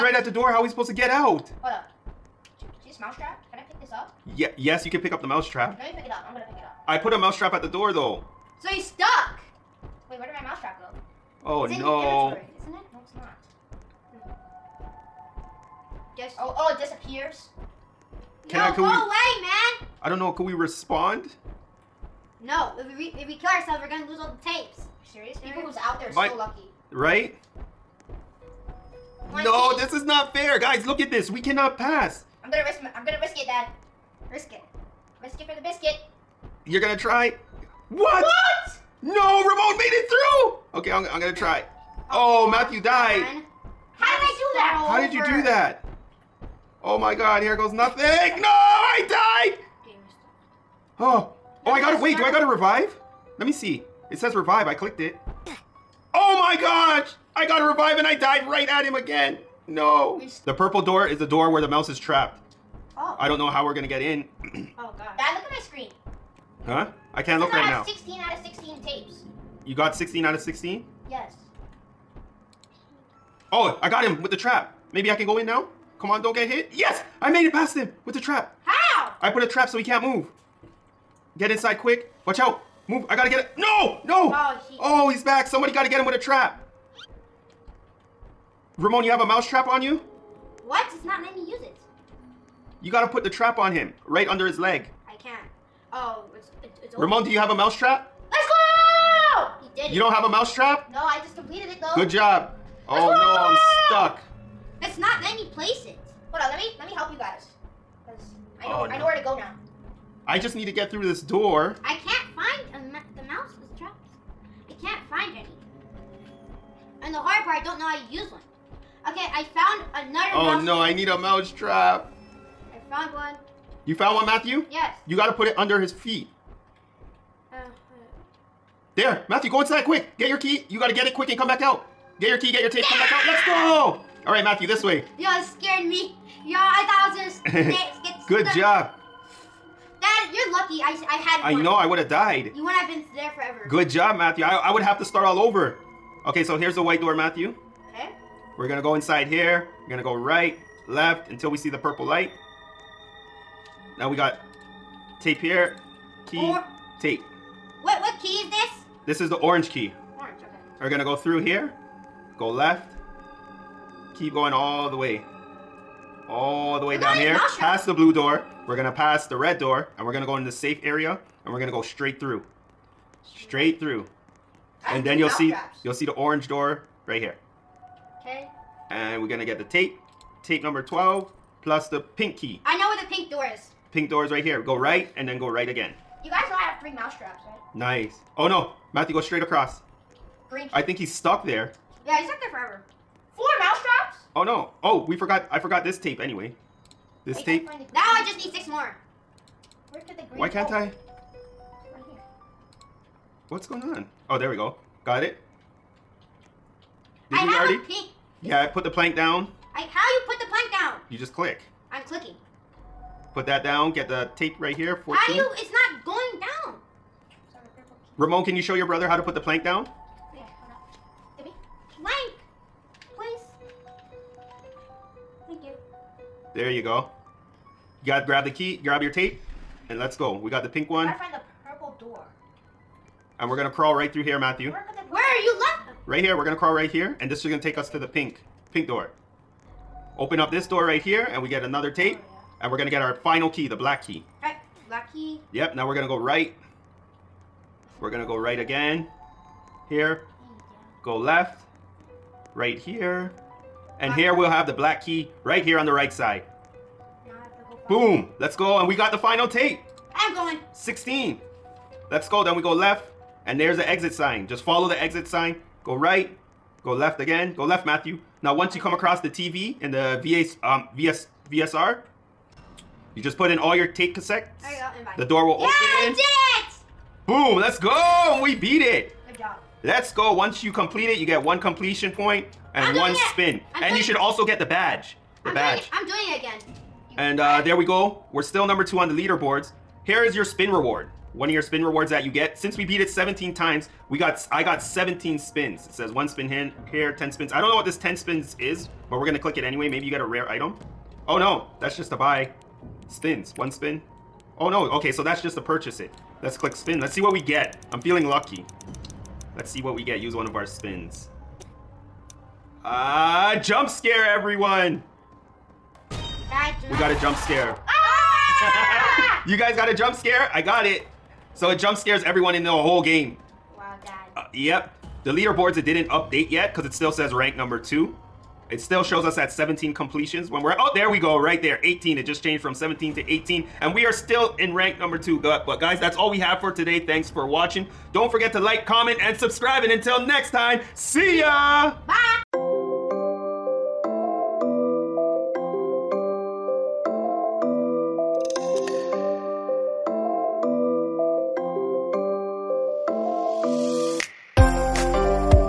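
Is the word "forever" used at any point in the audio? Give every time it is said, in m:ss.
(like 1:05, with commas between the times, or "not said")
2:23, 3:12.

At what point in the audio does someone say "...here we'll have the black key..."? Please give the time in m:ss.
4:14.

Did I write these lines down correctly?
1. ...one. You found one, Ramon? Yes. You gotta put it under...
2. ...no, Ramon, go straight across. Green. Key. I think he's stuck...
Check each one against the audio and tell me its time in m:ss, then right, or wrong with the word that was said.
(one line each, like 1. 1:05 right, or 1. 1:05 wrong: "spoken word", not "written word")
1. 2:03 wrong: "Matthew", not "Ramon"
2. 3:08 wrong: "Matthew", not "Ramon".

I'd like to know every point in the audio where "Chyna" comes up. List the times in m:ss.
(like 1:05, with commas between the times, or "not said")
not said.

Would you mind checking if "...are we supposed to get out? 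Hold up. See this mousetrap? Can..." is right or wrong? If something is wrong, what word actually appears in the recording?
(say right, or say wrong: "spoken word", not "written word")
right.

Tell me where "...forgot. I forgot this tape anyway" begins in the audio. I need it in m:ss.
3:15.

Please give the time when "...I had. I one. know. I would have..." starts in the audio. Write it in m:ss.
2:21.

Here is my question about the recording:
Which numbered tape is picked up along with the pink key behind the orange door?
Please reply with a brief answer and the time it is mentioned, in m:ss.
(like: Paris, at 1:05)
12, at 3:00.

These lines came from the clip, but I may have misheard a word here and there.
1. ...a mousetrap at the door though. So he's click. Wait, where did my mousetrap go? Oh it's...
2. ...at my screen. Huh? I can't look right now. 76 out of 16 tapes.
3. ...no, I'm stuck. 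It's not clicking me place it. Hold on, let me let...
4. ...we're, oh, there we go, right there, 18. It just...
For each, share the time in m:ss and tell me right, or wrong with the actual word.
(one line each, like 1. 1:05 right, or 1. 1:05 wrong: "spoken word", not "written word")
1. 0:07 wrong: "stuck", not "click"
2. 1:05 wrong: "16", not "76"
3. 1:43 wrong: "letting", not "clicking"
4. 5:30 right.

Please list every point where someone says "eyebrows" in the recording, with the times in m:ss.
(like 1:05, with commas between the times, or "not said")
2:16.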